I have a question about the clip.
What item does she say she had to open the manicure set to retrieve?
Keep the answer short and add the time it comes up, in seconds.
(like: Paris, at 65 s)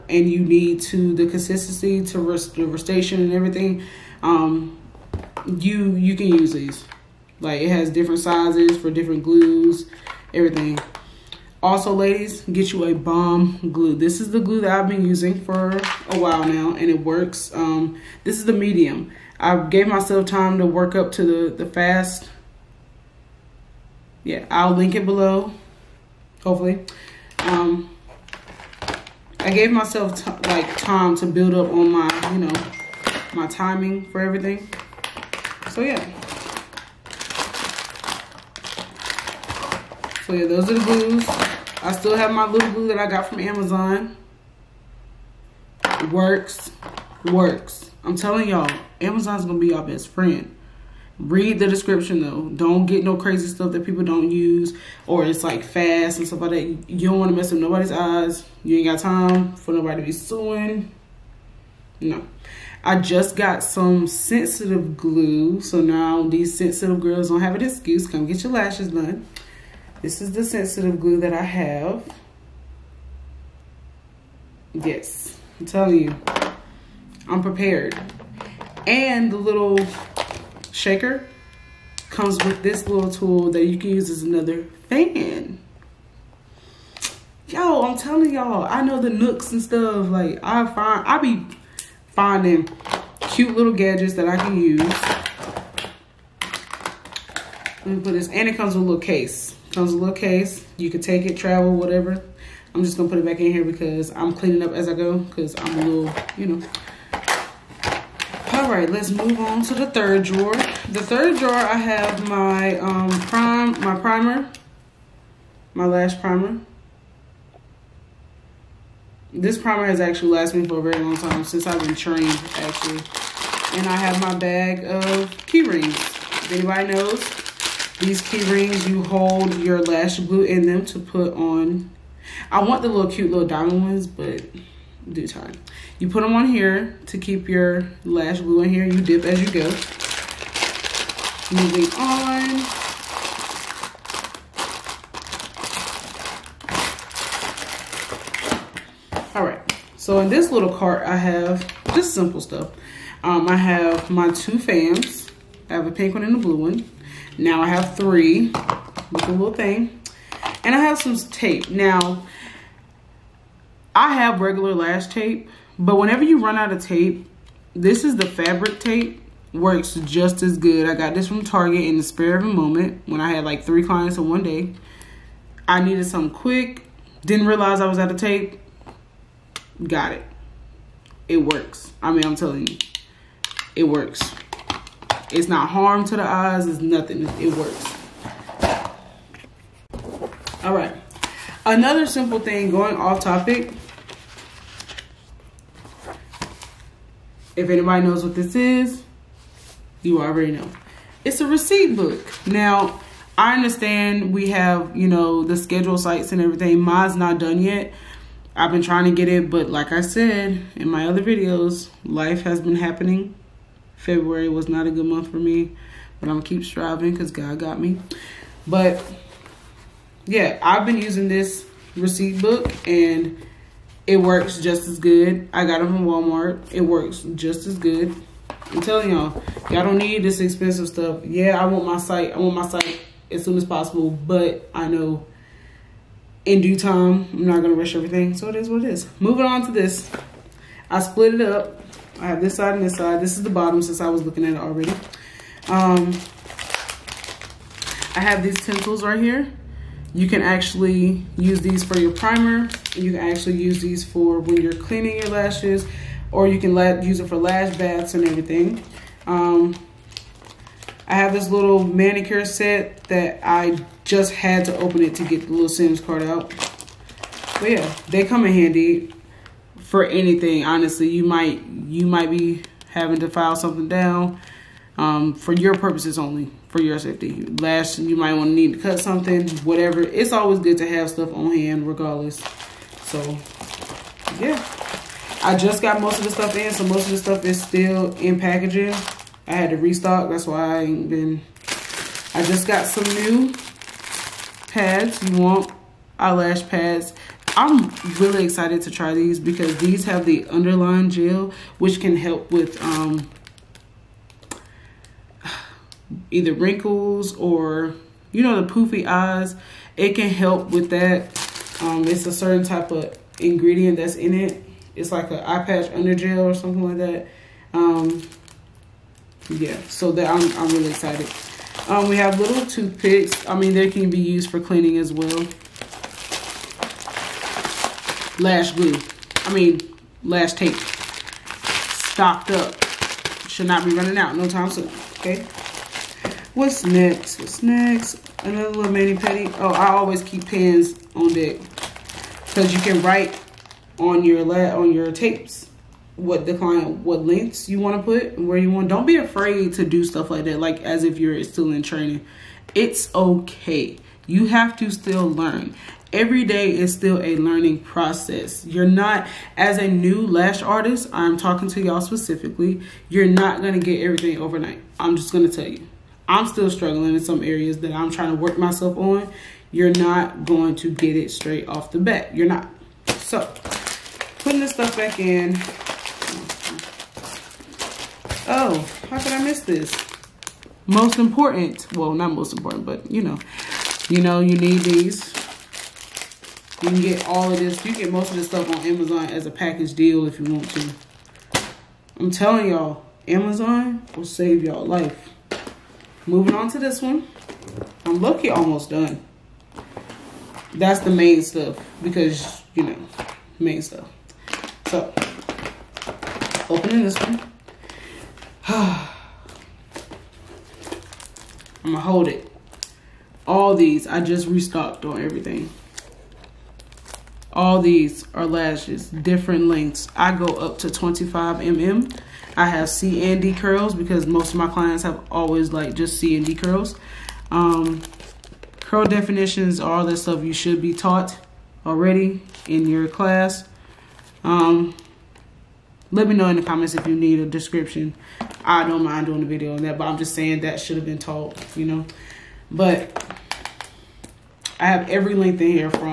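Sims card, at 265 s.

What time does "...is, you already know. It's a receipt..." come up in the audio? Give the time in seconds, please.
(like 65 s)
198 s.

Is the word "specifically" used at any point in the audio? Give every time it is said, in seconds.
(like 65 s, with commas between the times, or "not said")
362 s.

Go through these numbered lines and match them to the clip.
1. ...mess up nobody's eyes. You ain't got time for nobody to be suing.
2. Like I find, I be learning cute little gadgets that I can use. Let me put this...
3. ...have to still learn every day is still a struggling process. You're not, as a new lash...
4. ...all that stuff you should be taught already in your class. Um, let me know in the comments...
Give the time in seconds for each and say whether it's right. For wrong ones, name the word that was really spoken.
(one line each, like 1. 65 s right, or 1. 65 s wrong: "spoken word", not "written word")
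1. 57 s right
2. 90 s wrong: "finding", not "learning"
3. 354 s wrong: "learning", not "struggling"
4. 429 s right.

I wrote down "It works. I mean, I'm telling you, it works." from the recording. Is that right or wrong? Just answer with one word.
right.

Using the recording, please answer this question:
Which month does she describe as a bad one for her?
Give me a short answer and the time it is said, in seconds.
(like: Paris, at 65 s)
February, at 213 s.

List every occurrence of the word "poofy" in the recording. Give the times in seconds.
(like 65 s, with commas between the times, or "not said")
308 s.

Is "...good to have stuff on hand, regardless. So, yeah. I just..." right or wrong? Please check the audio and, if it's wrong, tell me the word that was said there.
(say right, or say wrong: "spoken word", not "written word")
right.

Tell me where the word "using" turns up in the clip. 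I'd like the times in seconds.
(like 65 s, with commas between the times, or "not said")
15 s, 220 s.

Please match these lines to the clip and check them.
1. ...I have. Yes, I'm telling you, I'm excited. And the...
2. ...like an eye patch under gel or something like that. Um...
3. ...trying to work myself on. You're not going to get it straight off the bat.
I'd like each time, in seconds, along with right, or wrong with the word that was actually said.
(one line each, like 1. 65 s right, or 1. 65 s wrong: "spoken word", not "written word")
1. 71 s wrong: "prepared", not "excited"
2. 315 s right
3. 368 s right.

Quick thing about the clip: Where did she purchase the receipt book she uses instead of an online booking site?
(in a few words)
Walmart.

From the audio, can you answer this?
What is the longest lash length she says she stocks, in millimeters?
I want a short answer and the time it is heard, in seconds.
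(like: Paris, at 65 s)
25 mm, at 420 s.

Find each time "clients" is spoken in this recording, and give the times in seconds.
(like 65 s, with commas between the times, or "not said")
173 s, 346 s, 424 s.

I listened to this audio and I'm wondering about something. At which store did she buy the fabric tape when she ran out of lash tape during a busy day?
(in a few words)
Target.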